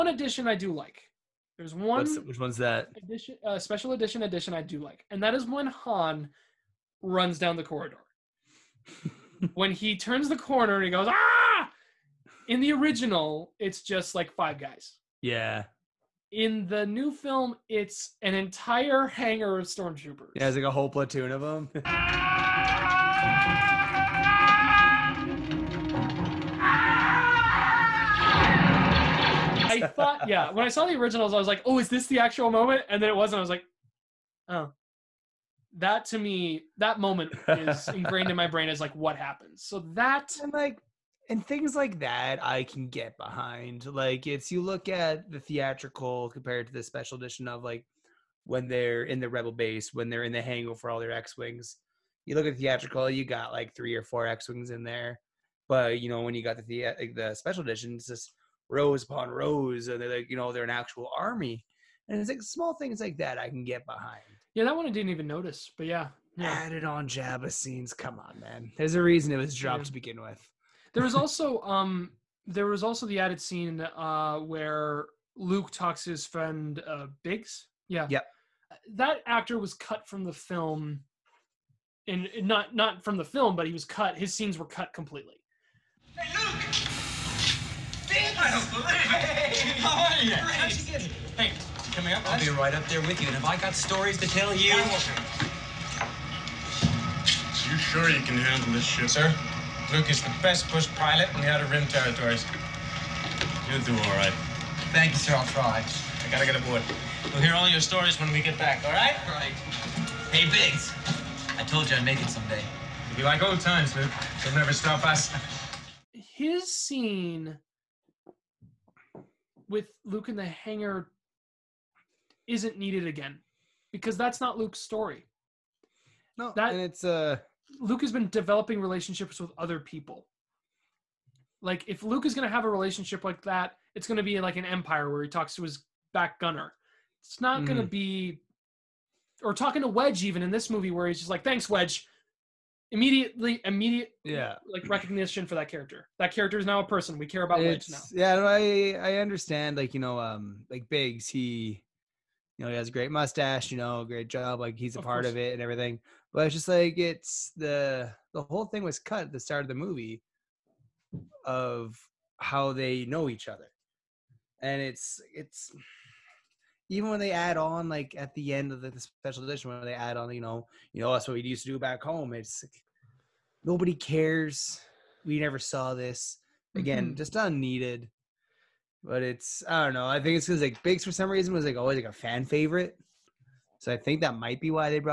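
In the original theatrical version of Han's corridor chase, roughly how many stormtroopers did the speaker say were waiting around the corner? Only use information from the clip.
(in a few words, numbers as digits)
5.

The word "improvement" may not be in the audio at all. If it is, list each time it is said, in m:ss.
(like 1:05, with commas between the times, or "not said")
not said.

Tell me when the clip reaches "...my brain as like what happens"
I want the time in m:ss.
0:38.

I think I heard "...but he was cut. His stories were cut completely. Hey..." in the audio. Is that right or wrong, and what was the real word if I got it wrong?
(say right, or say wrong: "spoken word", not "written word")
wrong: "scenes", not "stories".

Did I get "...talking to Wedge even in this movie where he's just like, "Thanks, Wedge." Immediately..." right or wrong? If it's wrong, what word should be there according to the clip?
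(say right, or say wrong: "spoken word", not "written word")
right.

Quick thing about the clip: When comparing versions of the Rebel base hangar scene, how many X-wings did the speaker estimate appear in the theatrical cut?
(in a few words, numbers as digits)
3 or 4.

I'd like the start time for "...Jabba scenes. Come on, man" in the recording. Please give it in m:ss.
1:07.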